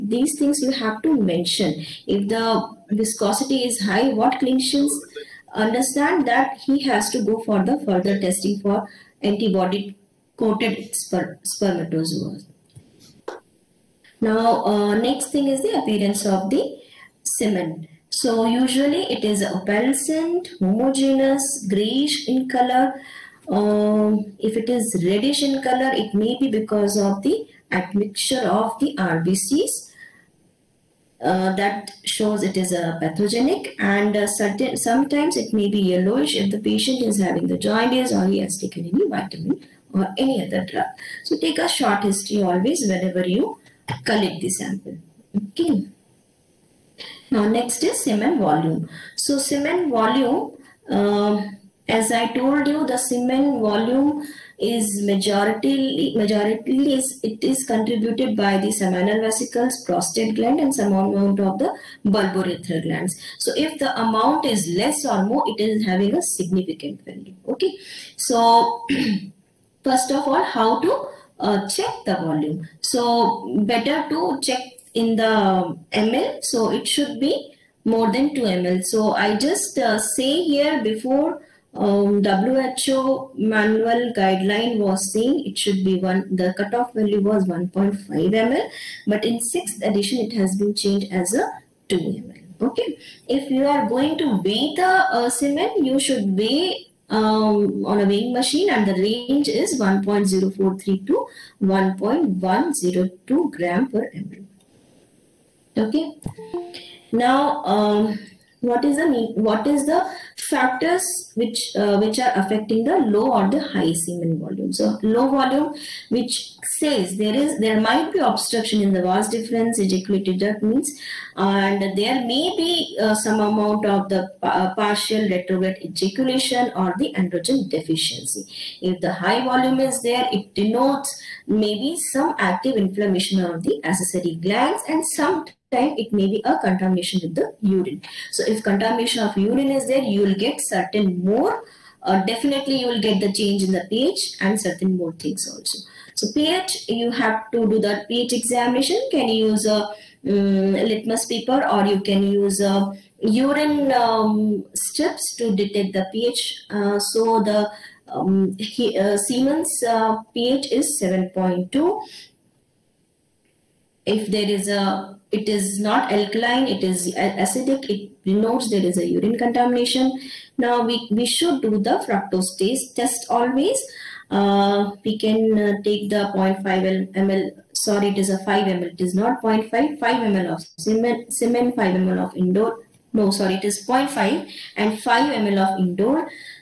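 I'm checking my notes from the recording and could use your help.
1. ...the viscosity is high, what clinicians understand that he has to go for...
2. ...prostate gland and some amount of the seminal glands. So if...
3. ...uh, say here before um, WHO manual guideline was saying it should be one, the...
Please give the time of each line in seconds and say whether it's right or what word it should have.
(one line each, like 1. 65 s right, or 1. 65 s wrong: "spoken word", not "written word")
1. 2 s right
2. 59 s wrong: "bulbourethral", not "seminal"
3. 79 s right.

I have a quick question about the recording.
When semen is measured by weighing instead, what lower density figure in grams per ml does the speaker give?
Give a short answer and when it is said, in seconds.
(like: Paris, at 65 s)
1.043, at 99 s.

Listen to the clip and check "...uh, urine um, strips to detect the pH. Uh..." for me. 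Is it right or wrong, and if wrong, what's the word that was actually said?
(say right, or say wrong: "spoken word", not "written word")
right.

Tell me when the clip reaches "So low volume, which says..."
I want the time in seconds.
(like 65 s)
114 s.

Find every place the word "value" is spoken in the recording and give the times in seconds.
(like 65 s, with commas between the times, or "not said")
67 s, 86 s.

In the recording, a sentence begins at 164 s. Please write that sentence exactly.
If there is a, it is not alkaline, it is acidic, it denotes there is a urine contamination.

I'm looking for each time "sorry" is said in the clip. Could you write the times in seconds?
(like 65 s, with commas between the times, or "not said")
177 s, 183 s.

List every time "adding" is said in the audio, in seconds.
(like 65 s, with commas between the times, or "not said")
not said.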